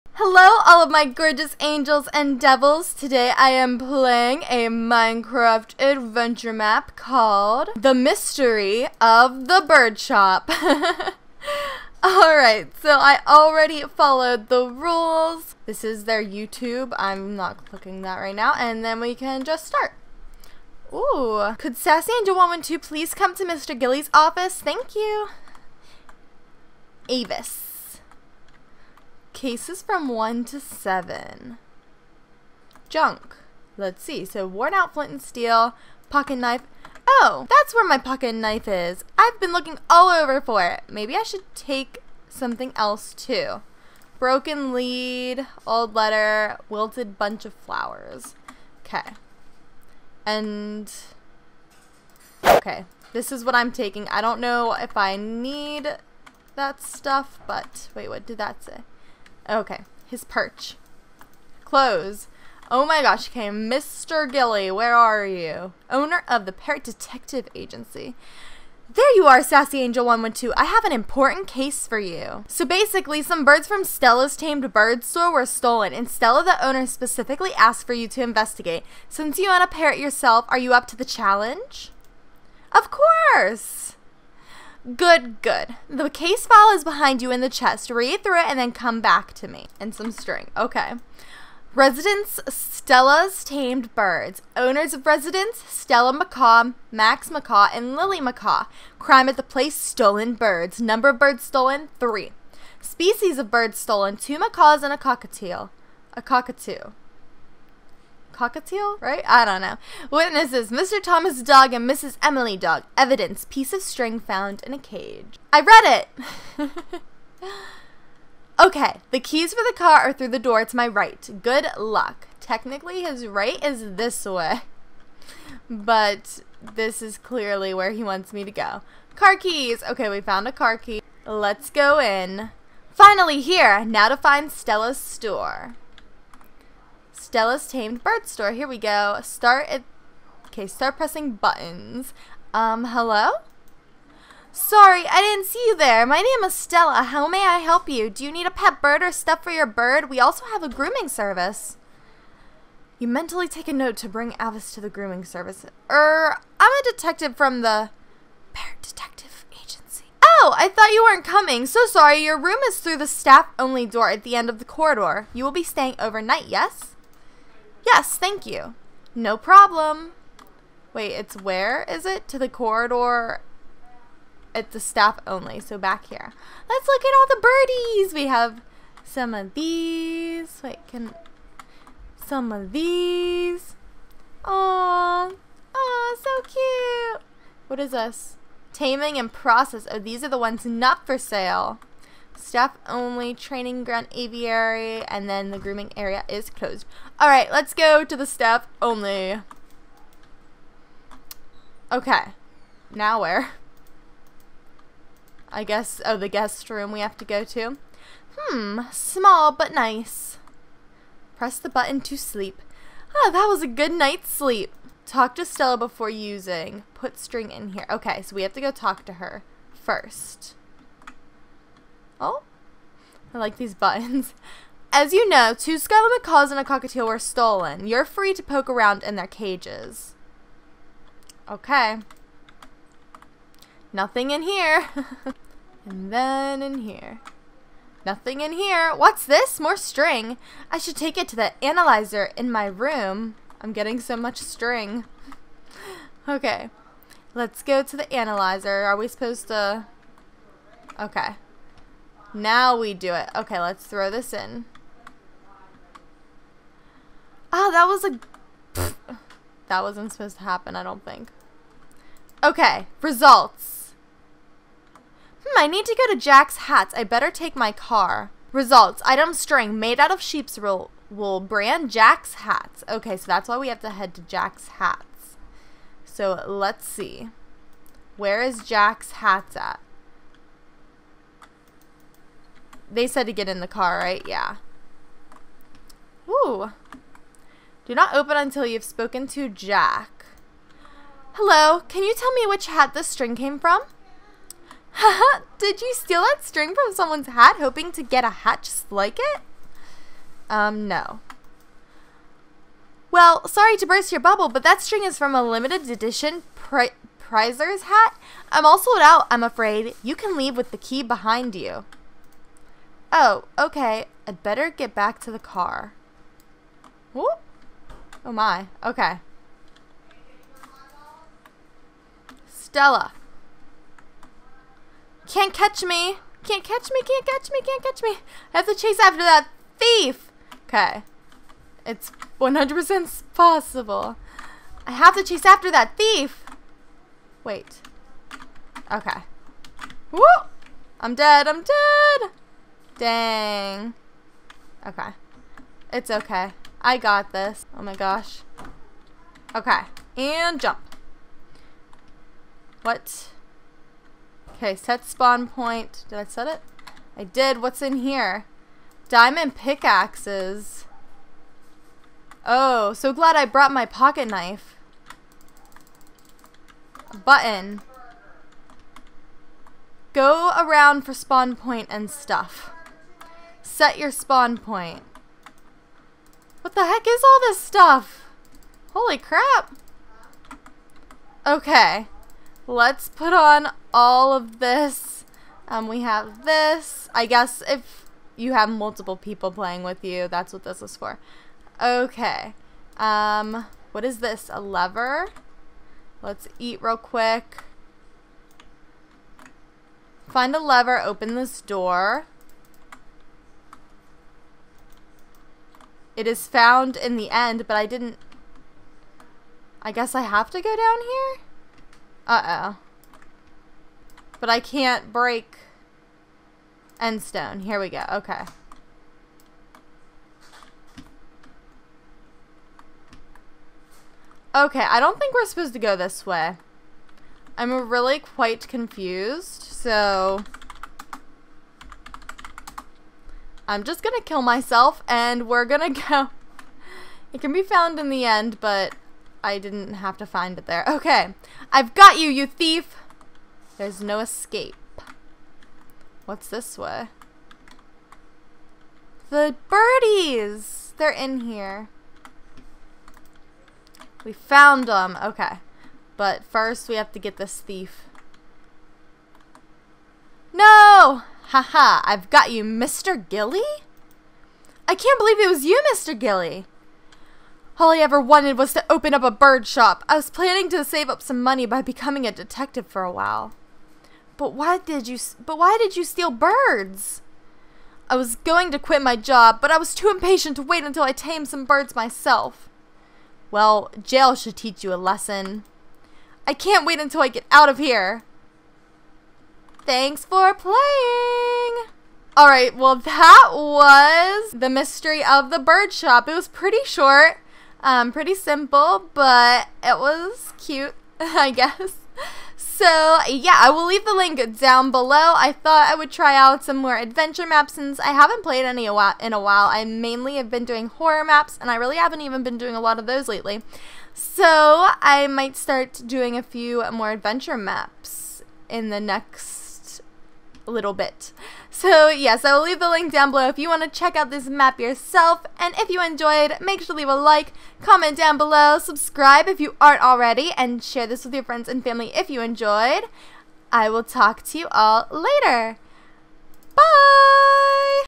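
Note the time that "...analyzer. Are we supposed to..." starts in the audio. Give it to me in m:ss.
4:08.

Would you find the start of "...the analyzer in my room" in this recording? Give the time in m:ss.
4:01.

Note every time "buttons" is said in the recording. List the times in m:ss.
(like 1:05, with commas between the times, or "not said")
2:21, 3:31, 3:43, 6:07.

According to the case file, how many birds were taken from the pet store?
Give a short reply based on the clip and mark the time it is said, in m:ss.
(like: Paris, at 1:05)
3, at 1:41.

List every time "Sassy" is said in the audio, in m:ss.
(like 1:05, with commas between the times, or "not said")
0:21, 1:09.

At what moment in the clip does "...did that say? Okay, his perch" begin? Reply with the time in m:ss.
0:58.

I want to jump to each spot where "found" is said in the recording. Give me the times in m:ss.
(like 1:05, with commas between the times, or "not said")
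1:54, 2:10, 6:46, 7:17, 7:34.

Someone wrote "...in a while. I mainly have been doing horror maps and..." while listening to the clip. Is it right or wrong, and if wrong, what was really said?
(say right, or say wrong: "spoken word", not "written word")
right.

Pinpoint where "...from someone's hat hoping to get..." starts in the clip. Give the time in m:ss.
4:56.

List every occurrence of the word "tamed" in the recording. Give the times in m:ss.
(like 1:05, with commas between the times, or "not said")
1:14, 1:33, 2:17, 8:01.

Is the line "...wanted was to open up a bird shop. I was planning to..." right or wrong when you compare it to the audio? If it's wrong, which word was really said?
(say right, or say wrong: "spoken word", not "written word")
right.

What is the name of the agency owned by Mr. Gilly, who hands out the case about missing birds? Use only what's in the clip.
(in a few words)
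Parrot Detective Agency.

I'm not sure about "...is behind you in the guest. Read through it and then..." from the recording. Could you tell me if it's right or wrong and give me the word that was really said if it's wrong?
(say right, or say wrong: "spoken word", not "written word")
wrong: "chest", not "guest".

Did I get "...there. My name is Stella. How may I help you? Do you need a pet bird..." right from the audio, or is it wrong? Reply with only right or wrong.
right.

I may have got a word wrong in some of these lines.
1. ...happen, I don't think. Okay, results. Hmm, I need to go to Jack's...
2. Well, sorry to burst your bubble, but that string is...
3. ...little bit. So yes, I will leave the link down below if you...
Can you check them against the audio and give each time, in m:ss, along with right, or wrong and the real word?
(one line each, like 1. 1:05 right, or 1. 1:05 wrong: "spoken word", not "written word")
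1. 4:20 right
2. 5:03 right
3. 8:40 right.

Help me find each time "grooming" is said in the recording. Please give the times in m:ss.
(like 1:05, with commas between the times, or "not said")
2:30, 2:34, 3:15.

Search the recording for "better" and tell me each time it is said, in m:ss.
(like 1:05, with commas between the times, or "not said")
4:27, 5:14.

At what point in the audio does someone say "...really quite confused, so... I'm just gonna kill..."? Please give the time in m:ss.
7:07.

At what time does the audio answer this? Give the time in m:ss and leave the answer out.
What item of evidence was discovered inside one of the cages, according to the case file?
1:53.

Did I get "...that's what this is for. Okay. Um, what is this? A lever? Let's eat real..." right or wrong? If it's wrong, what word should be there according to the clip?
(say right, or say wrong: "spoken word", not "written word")
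right.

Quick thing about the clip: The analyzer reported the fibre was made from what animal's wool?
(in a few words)
Sheep.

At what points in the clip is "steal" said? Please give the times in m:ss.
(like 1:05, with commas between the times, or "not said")
4:55, 7:56.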